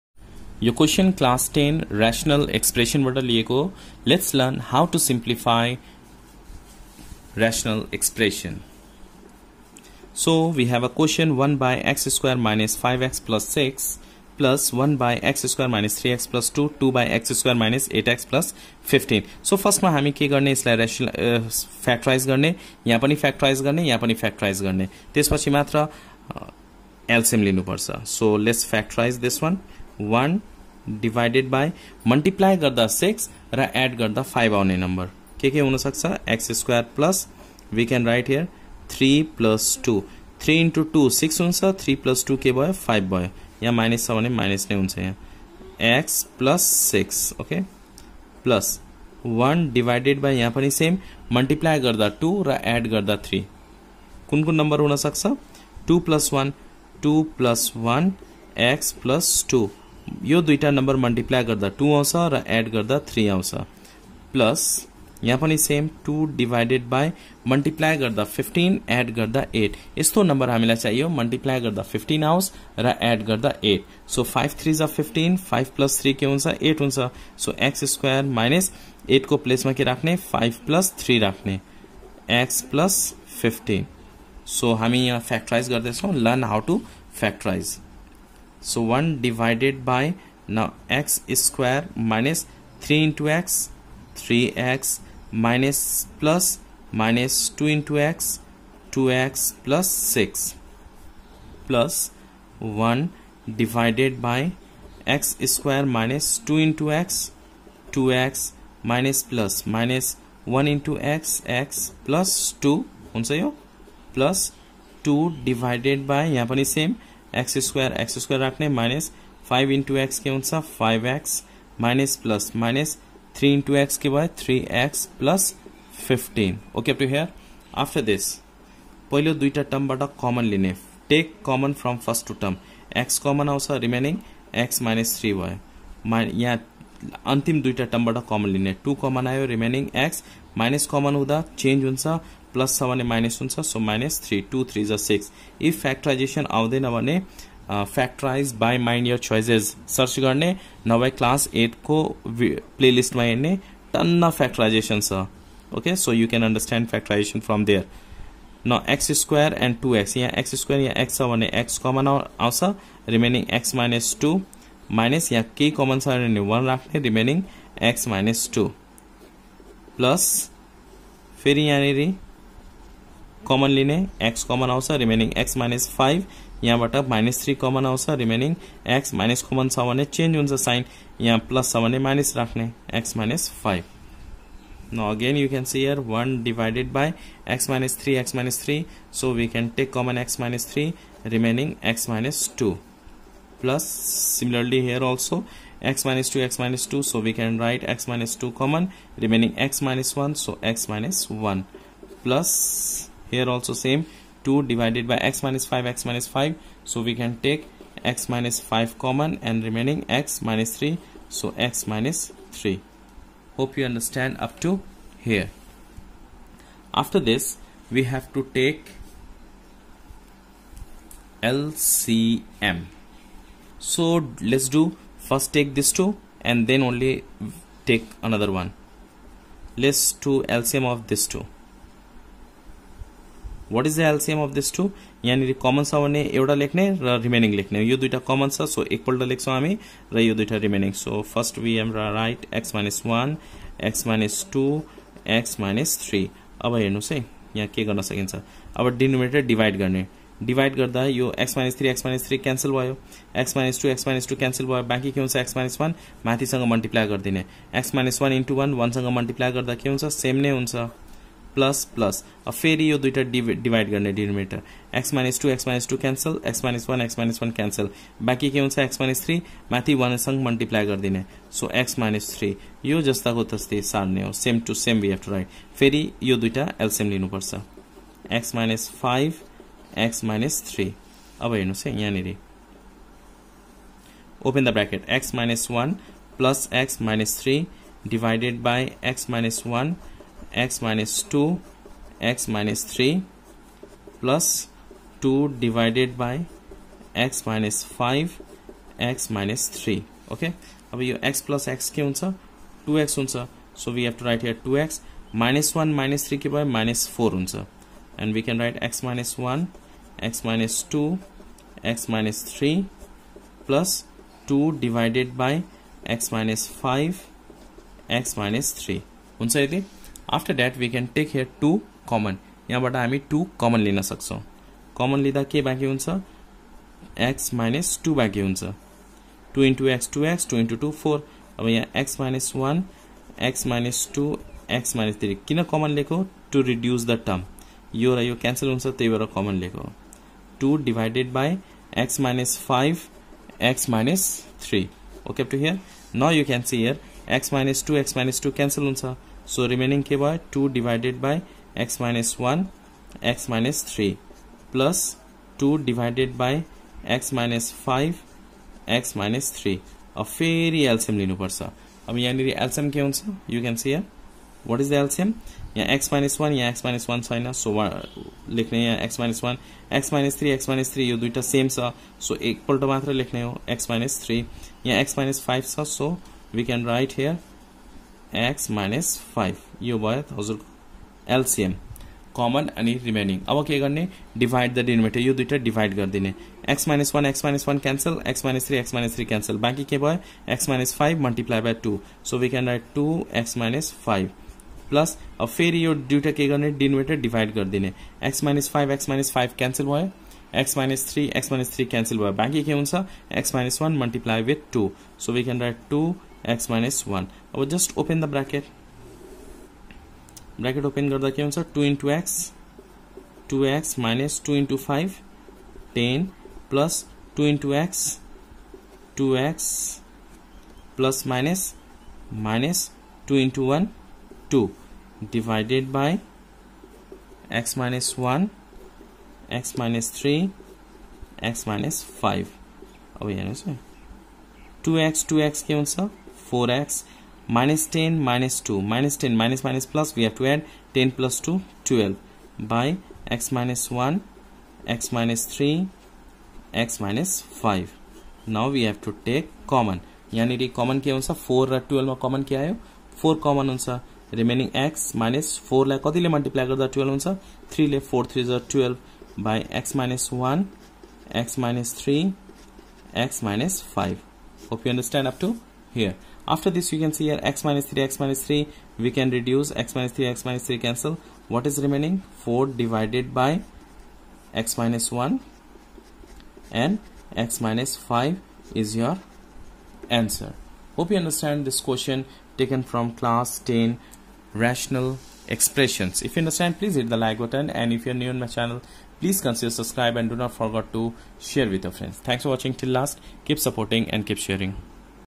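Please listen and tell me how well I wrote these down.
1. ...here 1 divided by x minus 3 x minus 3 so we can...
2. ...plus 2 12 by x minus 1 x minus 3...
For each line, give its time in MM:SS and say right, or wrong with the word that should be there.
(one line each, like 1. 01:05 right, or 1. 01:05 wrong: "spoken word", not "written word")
1. 03:05 right
2. 07:21 right.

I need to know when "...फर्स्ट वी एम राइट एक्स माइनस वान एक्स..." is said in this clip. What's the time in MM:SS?
04:01.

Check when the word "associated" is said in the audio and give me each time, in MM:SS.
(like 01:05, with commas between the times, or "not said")
not said.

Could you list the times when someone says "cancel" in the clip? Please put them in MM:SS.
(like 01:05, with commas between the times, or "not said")
07:15, 07:50.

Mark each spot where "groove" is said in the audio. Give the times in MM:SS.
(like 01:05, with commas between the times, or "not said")
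not said.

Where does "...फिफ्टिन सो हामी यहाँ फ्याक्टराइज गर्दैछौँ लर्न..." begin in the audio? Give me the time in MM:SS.
01:23.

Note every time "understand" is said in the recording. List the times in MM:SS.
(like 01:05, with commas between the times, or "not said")
03:33, 07:44, 08:01, 08:06.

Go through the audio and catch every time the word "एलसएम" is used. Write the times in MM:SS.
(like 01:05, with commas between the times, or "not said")
03:54, 04:36, 06:21.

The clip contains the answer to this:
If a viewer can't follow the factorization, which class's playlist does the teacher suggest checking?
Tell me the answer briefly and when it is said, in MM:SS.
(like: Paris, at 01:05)
Class 8, at 02:31.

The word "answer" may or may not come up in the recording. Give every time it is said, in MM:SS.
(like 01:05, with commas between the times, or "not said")
07:33, 08:00.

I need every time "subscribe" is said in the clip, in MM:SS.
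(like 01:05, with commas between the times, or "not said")
08:09.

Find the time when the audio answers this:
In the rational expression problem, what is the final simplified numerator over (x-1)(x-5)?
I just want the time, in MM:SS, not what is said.
07:52.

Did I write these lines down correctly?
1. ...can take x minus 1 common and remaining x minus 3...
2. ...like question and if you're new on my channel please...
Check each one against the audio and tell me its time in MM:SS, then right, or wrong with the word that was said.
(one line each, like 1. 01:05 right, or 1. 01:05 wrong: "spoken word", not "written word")
1. 03:27 wrong: "5", not "1"
2. 08:07 wrong: "button", not "question".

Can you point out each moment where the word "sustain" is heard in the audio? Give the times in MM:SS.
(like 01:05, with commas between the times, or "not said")
not said.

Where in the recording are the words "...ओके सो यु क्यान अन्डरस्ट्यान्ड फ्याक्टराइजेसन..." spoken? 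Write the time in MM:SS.
02:35.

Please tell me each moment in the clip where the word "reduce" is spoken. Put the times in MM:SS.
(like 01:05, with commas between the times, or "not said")
07:49.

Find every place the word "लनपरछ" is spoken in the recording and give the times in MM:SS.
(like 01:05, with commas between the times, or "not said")
00:27, 04:37, 06:01.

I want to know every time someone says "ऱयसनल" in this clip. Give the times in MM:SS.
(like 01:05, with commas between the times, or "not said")
00:01, 00:07.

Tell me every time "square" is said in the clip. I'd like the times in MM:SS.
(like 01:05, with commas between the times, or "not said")
01:31, 01:45.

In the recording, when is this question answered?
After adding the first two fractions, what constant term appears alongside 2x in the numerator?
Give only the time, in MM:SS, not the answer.
05:06.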